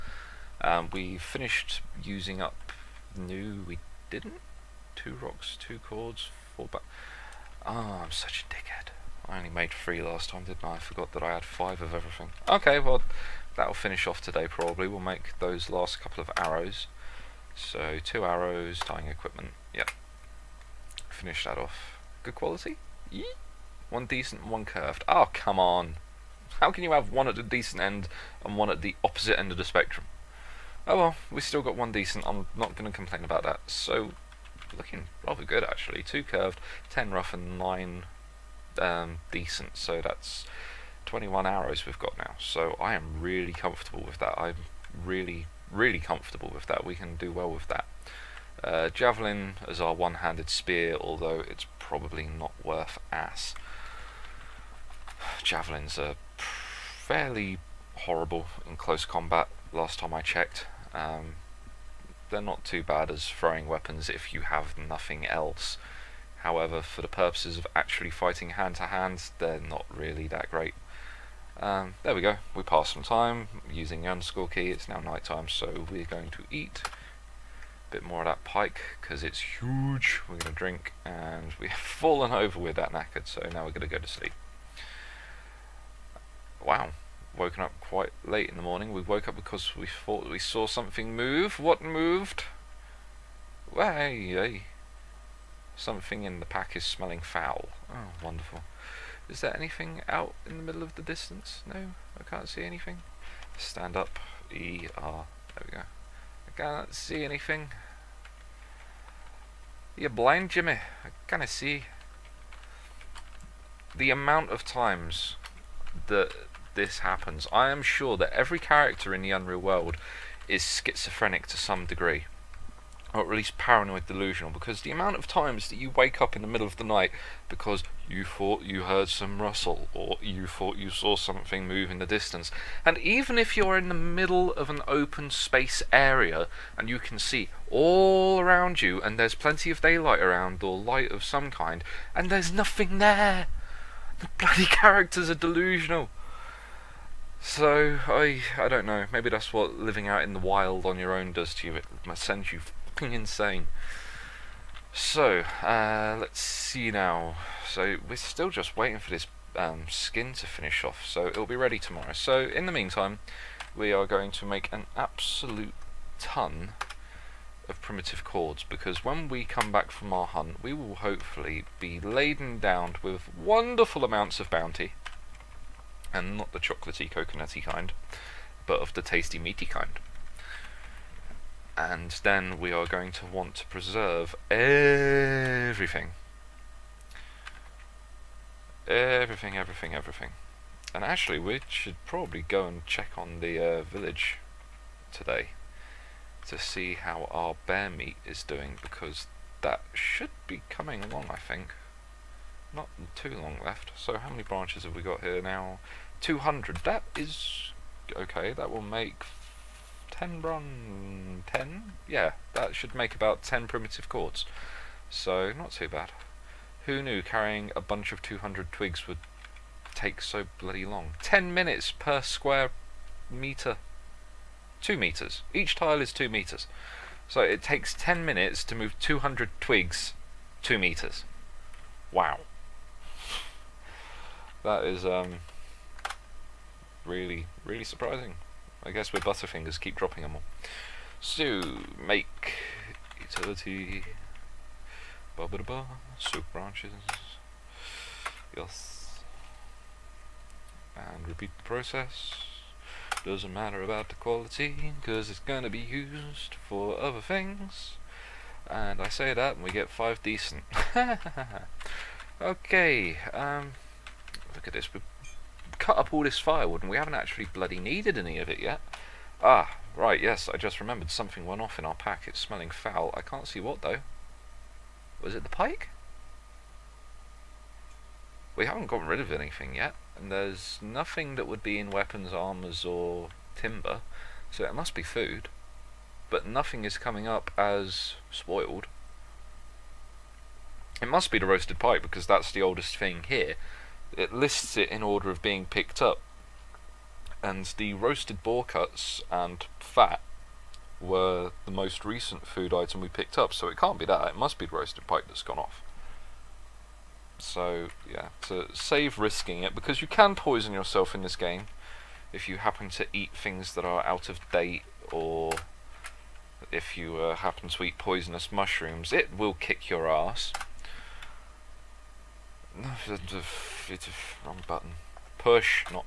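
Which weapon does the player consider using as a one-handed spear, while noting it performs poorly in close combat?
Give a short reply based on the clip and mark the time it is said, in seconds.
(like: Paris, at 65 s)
Javelin, at 48 s.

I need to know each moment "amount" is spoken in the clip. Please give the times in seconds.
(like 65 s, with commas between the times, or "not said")
114 s, 124 s, 174 s.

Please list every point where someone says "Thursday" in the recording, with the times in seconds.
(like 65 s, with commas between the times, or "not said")
not said.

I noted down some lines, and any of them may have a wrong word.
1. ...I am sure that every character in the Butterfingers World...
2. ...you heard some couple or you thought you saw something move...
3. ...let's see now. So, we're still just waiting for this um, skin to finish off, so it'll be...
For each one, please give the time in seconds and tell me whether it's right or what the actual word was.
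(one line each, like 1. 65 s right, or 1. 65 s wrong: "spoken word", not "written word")
1. 117 s wrong: "Unreal", not "Butterfingers"
2. 128 s wrong: "rustle", not "couple"
3. 156 s right.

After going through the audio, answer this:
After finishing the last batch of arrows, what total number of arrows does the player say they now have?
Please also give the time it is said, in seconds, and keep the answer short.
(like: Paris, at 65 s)
21, at 41 s.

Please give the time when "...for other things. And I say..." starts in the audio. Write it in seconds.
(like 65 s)
256 s.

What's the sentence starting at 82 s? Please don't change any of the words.
with that knackered, so now we're going to go to sleep.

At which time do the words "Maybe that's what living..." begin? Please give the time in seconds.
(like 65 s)
149 s.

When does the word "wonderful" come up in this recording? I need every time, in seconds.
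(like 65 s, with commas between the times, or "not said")
98 s, 173 s.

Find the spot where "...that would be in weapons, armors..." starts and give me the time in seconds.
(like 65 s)
281 s.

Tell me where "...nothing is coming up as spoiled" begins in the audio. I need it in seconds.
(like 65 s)
286 s.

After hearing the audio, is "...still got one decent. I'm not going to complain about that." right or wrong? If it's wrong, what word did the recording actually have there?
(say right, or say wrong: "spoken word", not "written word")
right.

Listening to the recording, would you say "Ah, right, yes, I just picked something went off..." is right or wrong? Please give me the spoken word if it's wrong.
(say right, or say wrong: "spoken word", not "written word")
wrong: "remembered", not "picked".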